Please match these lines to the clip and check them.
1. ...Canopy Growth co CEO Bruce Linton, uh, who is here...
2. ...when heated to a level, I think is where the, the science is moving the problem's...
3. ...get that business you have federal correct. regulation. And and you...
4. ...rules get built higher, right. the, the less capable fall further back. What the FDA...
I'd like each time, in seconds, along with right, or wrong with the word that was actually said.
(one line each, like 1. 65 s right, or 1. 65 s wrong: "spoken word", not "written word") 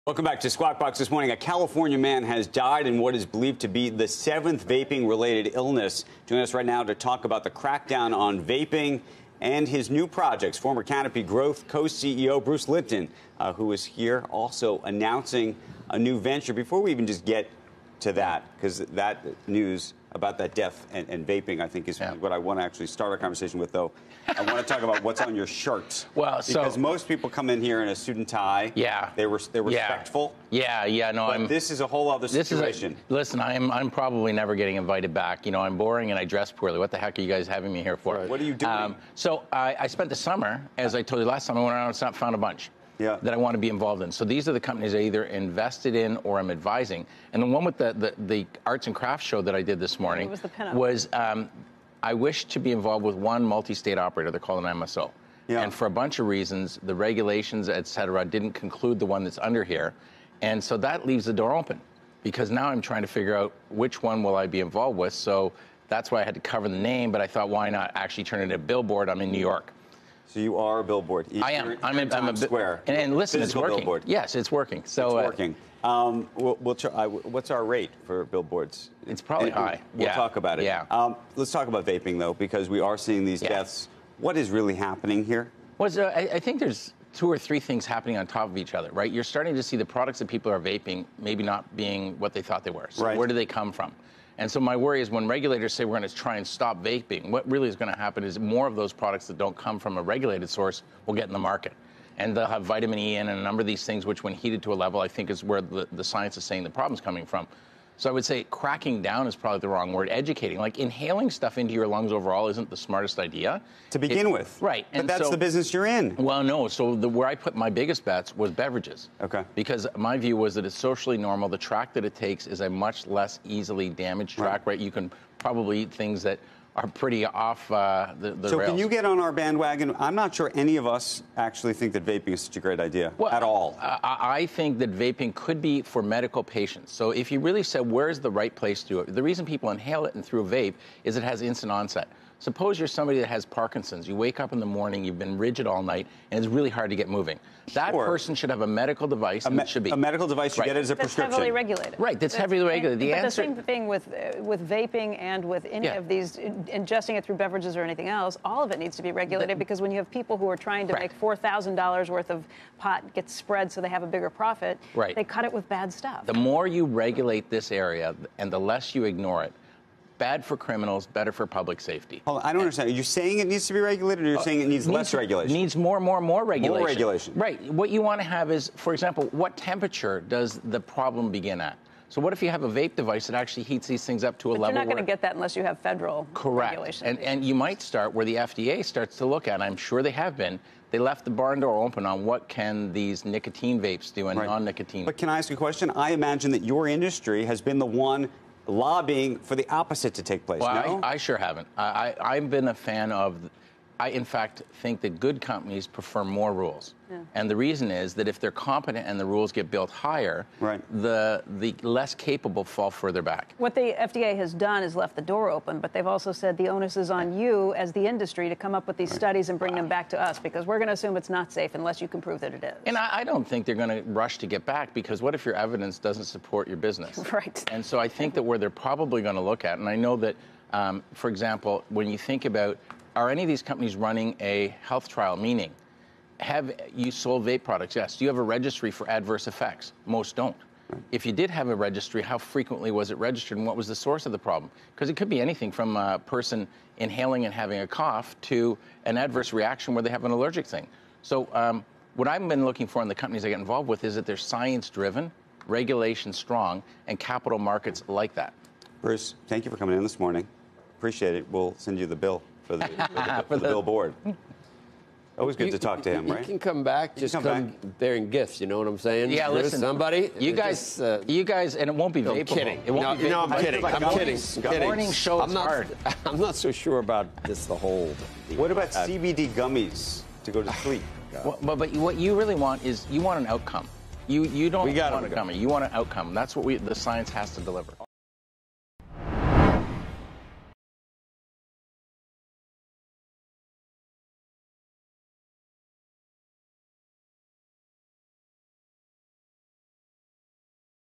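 1. 10 s right
2. 104 s wrong: "saying", not "moving"
3. 185 s wrong: "unless", not "business"
4. 209 s right.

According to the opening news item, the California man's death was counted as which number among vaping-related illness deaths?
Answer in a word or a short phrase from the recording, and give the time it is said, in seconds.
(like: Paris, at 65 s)
seventh, at 4 s.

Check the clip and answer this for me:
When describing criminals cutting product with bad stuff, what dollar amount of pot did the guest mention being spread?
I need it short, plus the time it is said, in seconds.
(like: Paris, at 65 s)
$4,000, at 161 s.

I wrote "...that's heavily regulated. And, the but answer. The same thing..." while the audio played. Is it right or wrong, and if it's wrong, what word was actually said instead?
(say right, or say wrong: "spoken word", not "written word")
right.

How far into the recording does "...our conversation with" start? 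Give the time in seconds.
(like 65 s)
23 s.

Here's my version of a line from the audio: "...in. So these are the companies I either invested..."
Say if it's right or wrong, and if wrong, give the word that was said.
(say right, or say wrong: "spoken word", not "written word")
right.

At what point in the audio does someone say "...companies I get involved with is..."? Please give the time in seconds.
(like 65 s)
253 s.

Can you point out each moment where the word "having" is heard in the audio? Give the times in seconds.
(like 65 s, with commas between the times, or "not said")
37 s, 247 s.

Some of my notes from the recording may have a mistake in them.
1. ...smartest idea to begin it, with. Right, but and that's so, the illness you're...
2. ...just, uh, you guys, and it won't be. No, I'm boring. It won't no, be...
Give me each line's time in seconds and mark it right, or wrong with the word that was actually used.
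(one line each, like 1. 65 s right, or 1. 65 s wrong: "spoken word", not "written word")
1. 112 s wrong: "business", not "illness"
2. 270 s wrong: "kidding", not "boring".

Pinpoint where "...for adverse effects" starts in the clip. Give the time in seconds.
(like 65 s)
238 s.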